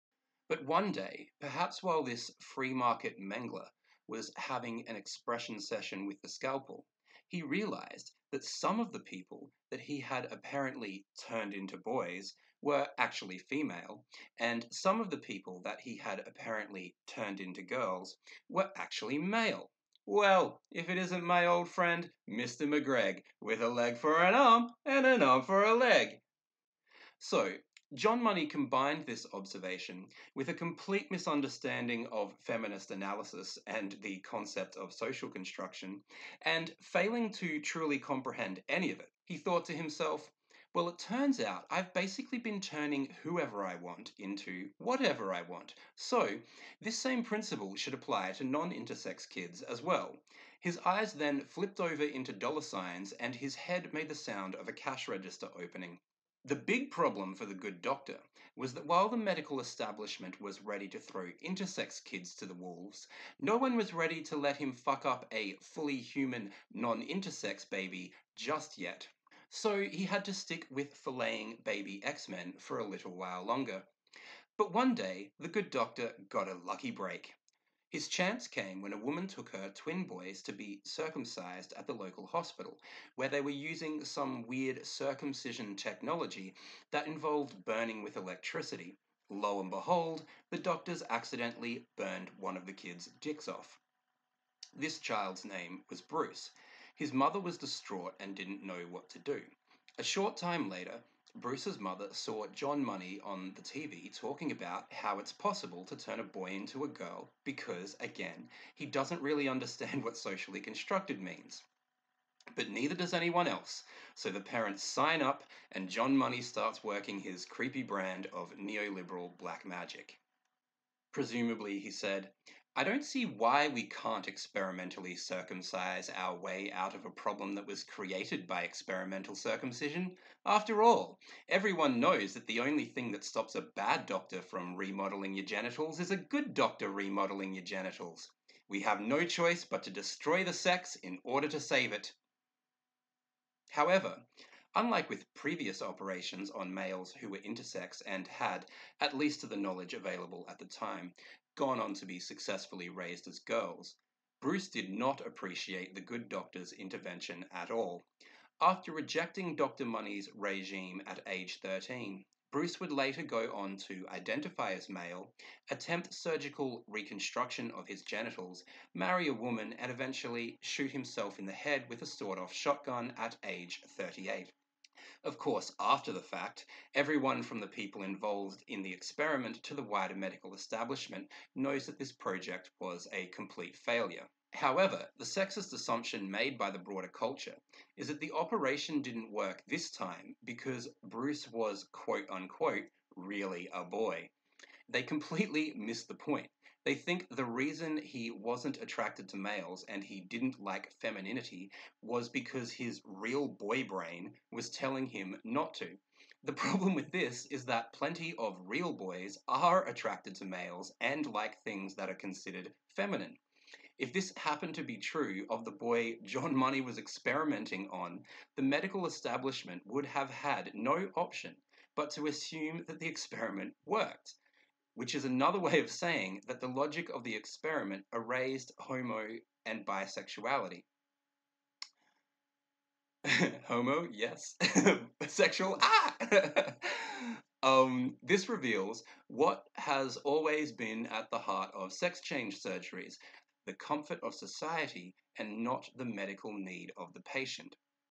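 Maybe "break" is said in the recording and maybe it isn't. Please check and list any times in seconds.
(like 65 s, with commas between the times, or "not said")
76 s.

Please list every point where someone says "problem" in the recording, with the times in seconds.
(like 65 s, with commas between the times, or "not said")
56 s, 127 s, 206 s.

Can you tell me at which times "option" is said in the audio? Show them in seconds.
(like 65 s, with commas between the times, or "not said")
221 s.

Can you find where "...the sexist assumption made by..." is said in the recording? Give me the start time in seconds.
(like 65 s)
185 s.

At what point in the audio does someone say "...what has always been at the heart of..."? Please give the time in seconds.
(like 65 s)
239 s.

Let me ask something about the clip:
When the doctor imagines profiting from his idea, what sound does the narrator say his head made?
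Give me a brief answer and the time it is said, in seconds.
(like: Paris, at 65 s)
A cash register opening, at 54 s.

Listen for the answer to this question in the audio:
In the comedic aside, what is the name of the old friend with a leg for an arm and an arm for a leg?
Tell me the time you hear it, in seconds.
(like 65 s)
22 s.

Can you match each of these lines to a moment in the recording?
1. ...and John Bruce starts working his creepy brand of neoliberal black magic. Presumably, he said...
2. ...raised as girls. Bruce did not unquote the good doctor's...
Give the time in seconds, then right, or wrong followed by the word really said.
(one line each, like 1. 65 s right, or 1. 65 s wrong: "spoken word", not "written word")
1. 115 s wrong: "Money", not "Bruce"
2. 152 s wrong: "appreciate", not "unquote".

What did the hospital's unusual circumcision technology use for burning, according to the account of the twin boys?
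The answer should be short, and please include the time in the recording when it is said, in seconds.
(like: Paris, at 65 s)
Electricity, at 88 s.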